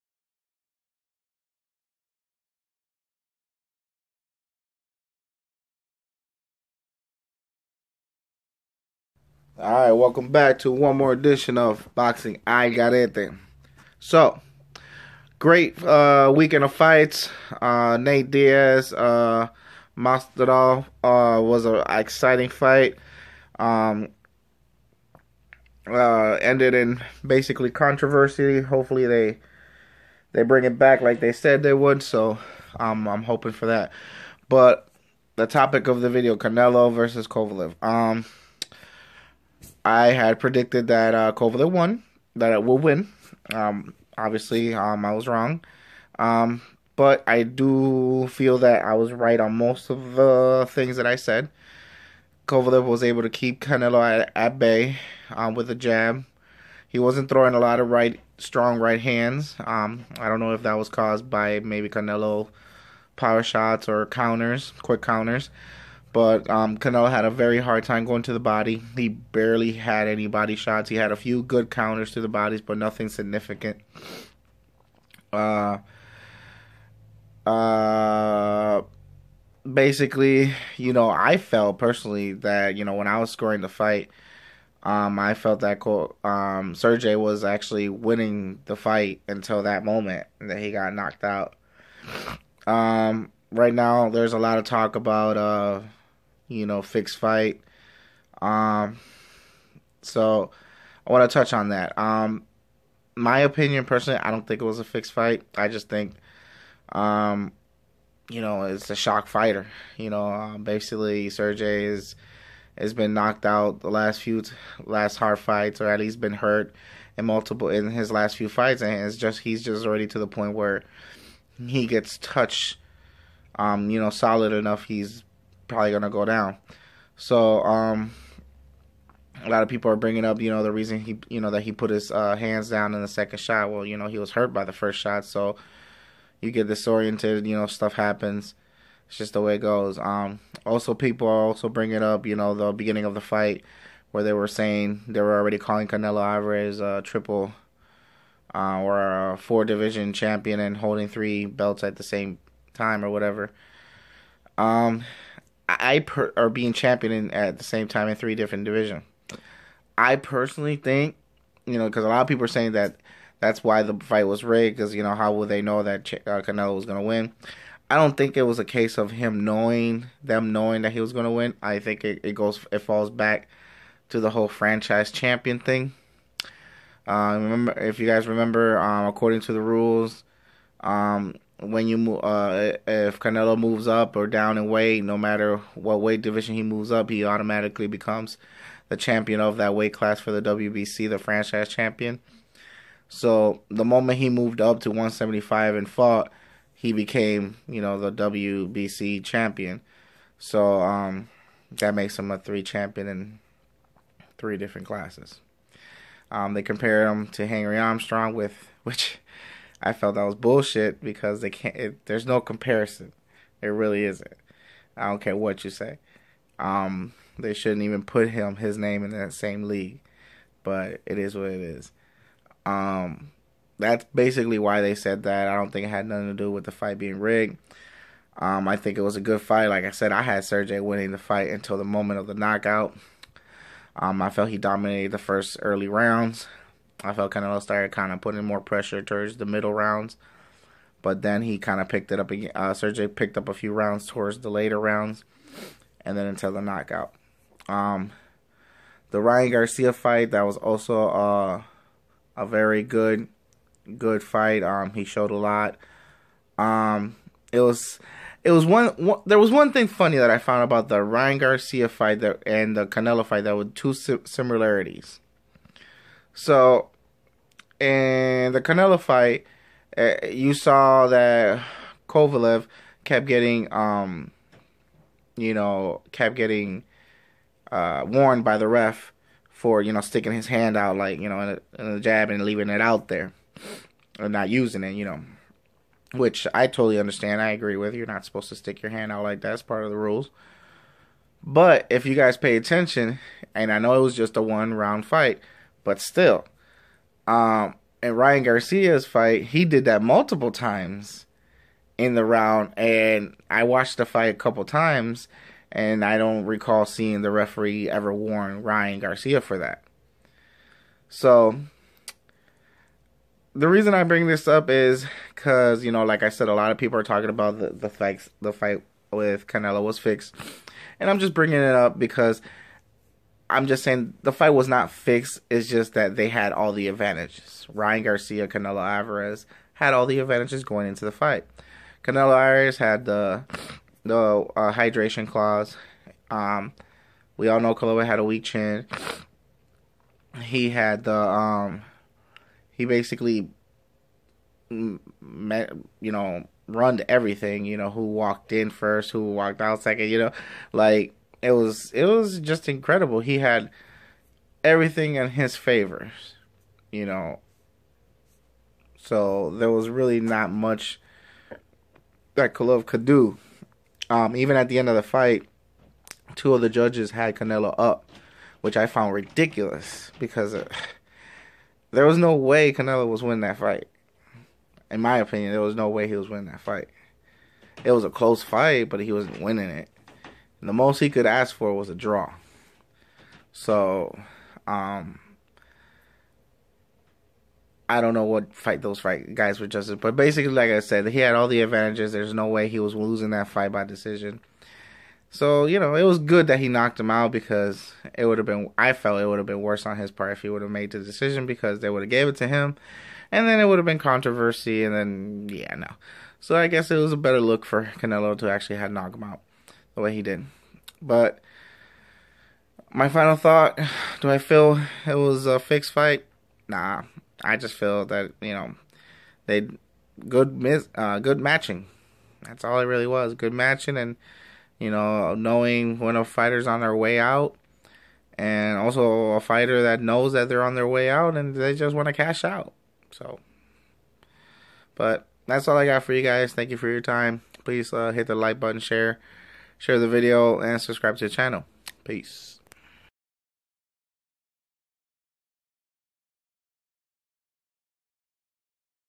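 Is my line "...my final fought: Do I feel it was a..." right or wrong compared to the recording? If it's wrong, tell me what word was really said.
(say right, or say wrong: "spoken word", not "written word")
wrong: "thought", not "fought".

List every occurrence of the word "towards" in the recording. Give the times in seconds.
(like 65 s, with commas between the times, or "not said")
239 s, 244 s.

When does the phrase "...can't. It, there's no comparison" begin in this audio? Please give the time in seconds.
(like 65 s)
211 s.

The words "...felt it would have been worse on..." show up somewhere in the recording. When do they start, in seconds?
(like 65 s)
398 s.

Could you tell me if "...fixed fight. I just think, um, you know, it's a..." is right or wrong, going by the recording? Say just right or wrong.
right.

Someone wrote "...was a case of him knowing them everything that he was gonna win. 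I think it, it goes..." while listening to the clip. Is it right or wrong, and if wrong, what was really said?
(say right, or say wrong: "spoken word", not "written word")
wrong: "knowing", not "everything".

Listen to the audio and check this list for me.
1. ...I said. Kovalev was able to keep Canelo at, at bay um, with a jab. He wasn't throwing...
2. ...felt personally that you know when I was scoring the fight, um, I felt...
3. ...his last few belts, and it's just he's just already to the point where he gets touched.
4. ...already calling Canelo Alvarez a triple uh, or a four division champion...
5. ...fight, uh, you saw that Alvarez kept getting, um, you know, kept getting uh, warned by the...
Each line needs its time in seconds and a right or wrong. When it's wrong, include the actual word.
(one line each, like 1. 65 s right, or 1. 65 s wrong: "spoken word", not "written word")
1. 51 s right
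2. 81 s right
3. 117 s wrong: "fights", not "belts"
4. 145 s right
5. 268 s wrong: "Kovalev", not "Alvarez".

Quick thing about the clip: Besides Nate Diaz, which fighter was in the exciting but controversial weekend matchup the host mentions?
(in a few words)
Masvidal.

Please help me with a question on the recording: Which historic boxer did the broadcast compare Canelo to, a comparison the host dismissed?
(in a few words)
Henry Armstrong.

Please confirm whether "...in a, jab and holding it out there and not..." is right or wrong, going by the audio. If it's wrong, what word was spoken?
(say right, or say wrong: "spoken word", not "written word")
wrong: "leaving", not "holding".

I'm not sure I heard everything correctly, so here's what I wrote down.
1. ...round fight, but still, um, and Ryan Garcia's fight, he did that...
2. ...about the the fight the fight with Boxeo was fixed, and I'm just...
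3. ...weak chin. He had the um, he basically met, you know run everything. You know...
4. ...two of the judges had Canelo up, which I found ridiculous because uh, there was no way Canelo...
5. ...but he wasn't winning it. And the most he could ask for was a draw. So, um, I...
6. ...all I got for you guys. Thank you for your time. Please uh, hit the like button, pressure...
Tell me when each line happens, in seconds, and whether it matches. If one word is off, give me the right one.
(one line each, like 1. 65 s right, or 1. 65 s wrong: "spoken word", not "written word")
1. 294 s right
2. 317 s wrong: "Canelo", not "Boxeo"
3. 338 s right
4. 366 s right
5. 378 s right
6. 435 s wrong: "share", not "pressure".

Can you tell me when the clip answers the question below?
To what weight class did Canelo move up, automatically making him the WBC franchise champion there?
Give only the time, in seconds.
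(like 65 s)
194 s.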